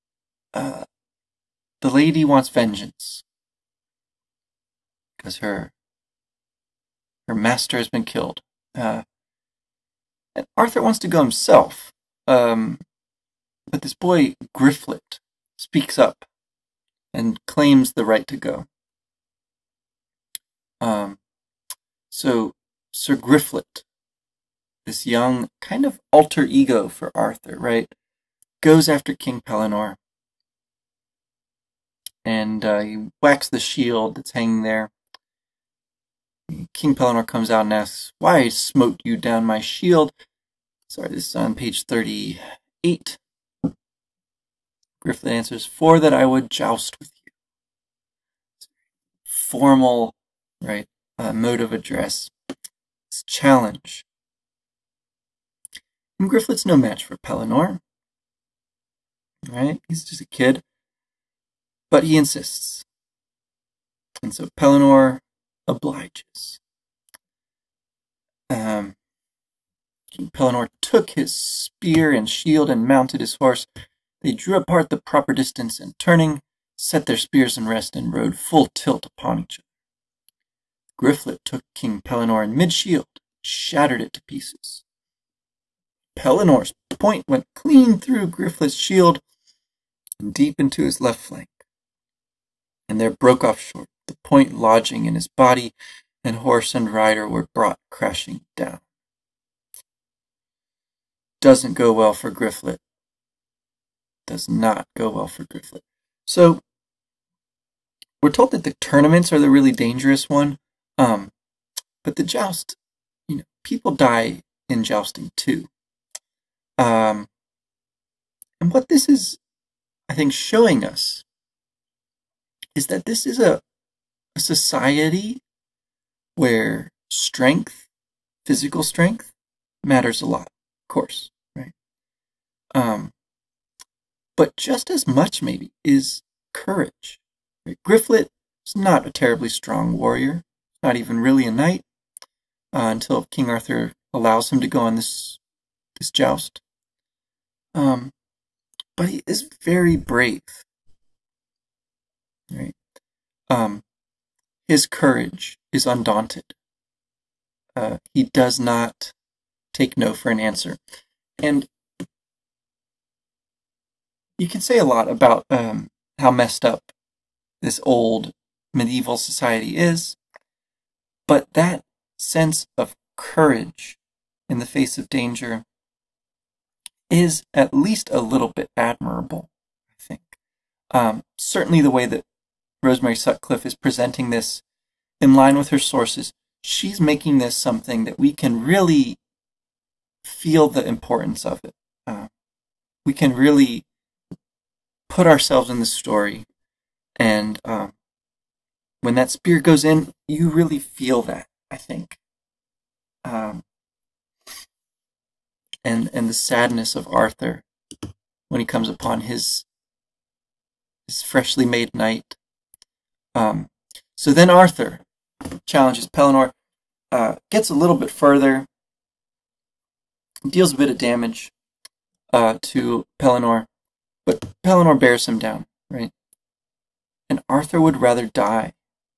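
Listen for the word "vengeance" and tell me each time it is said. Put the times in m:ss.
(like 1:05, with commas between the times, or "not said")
0:02.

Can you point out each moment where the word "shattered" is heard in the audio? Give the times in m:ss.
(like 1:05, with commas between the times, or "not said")
1:23.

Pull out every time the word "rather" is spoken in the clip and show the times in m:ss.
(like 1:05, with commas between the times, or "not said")
3:47.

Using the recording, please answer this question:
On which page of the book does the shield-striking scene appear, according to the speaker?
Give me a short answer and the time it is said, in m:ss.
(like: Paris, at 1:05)
38, at 0:41.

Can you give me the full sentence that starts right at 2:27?
Um, but he is very brave, right?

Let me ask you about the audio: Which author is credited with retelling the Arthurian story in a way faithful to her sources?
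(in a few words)
Rosemary Sutcliff.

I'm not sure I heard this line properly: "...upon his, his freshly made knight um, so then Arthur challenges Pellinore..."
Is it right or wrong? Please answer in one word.
right.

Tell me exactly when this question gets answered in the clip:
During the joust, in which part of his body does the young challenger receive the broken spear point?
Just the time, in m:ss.
1:30.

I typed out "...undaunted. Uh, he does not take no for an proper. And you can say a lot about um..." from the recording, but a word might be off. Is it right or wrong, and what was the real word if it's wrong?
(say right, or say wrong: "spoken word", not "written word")
wrong: "answer", not "proper".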